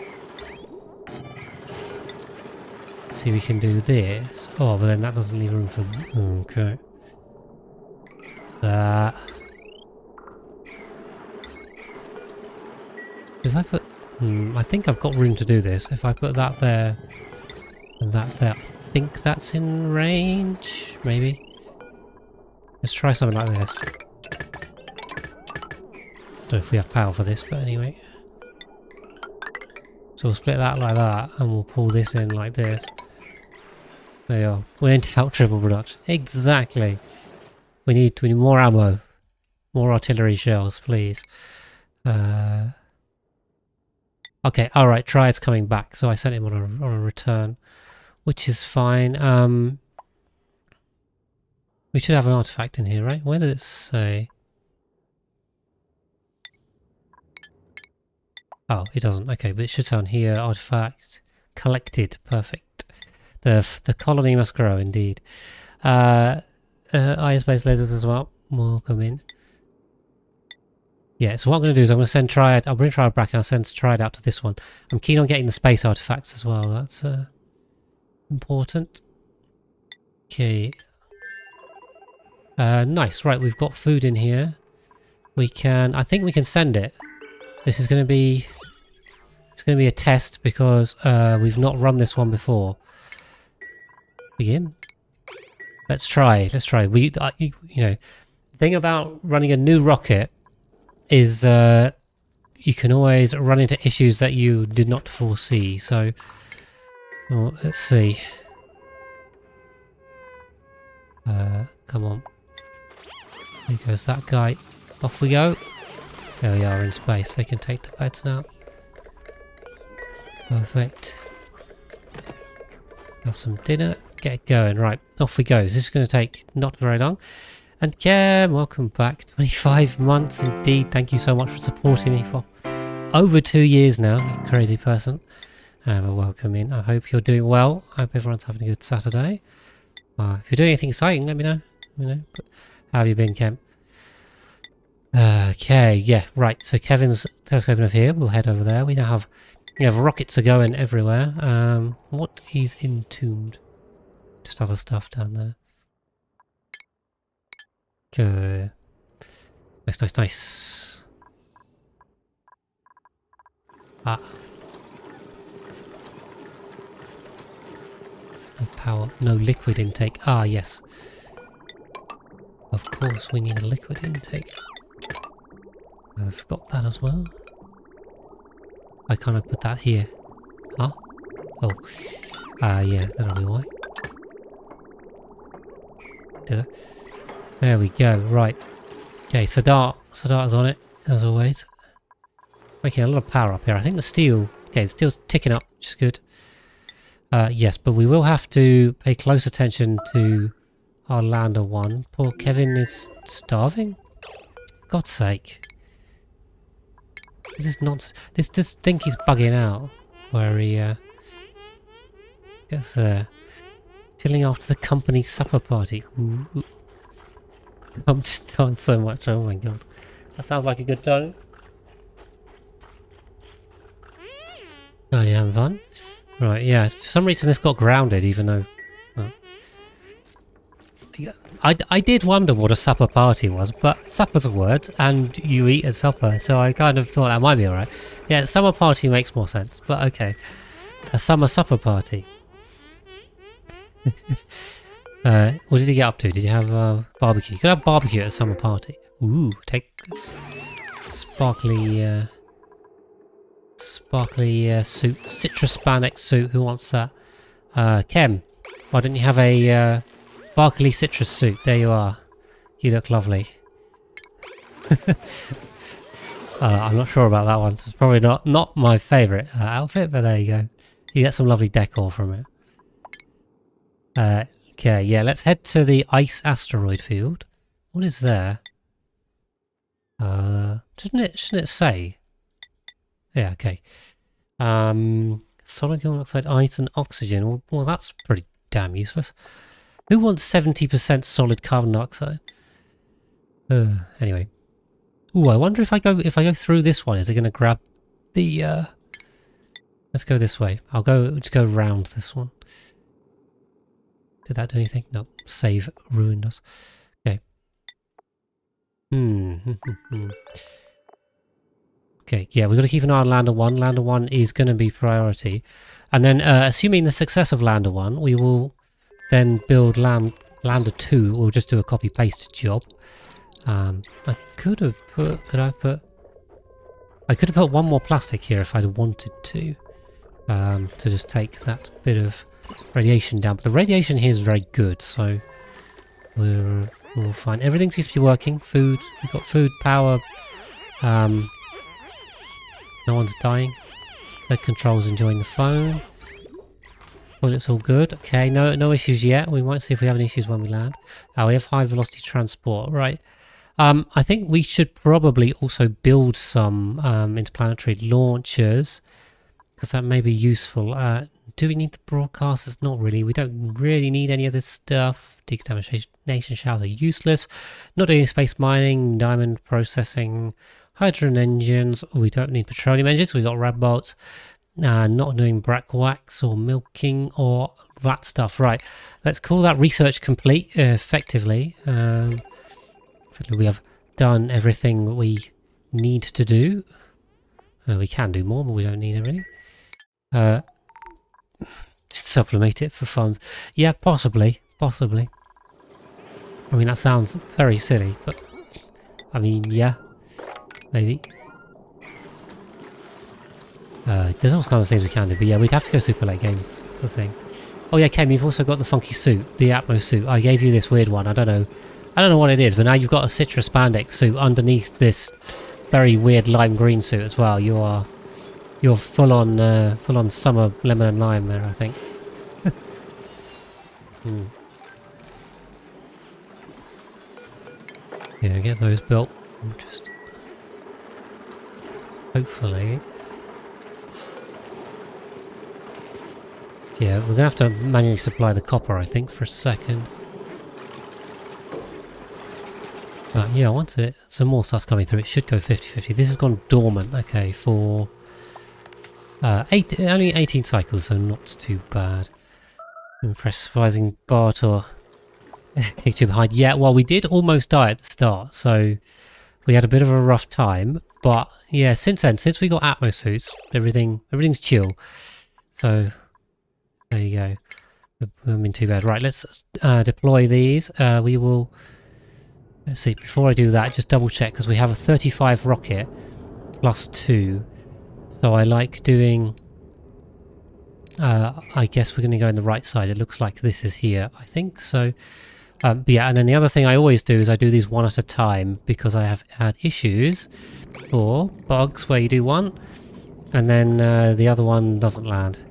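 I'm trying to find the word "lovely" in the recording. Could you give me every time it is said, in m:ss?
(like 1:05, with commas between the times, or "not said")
4:23, 4:31.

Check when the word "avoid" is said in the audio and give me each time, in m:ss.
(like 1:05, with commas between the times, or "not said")
not said.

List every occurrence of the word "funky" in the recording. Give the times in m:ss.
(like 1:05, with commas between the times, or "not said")
6:48.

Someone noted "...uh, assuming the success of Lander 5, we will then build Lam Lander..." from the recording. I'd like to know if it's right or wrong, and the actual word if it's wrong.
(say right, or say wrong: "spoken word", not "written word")
wrong: "1", not "5".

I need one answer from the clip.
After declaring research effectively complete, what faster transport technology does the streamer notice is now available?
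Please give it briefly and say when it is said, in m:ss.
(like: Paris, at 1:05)
high velocity transport, at 5:51.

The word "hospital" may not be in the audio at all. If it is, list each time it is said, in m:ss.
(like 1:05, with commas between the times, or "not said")
not said.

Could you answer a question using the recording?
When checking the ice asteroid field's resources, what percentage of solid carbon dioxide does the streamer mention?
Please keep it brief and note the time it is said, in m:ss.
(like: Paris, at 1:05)
70%, at 4:50.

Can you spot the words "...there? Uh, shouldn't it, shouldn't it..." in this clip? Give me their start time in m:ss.
4:38.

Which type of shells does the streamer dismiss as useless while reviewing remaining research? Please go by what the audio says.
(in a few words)
Decontamination shells.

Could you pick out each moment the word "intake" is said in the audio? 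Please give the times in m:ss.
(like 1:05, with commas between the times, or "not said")
2:49, 2:54.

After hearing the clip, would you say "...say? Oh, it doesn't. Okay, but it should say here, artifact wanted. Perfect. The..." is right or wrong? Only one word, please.
wrong.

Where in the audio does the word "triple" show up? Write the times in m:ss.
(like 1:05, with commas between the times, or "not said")
0:35.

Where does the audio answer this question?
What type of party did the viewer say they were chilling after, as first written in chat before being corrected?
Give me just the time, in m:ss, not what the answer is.
3:34.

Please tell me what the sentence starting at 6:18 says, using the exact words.
Right, let's call that research complete, uh, effectively.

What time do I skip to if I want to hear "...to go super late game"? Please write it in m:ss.
6:45.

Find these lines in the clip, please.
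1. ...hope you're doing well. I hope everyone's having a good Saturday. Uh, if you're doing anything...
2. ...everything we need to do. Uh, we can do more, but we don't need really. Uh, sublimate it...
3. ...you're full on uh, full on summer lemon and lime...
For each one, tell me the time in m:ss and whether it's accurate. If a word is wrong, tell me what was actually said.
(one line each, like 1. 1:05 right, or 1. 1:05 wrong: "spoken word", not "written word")
1. 2:16 right
2. 6:24 right
3. 6:58 right.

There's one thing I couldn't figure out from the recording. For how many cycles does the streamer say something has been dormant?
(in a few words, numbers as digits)
18.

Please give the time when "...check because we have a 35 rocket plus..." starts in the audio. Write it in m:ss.
7:54.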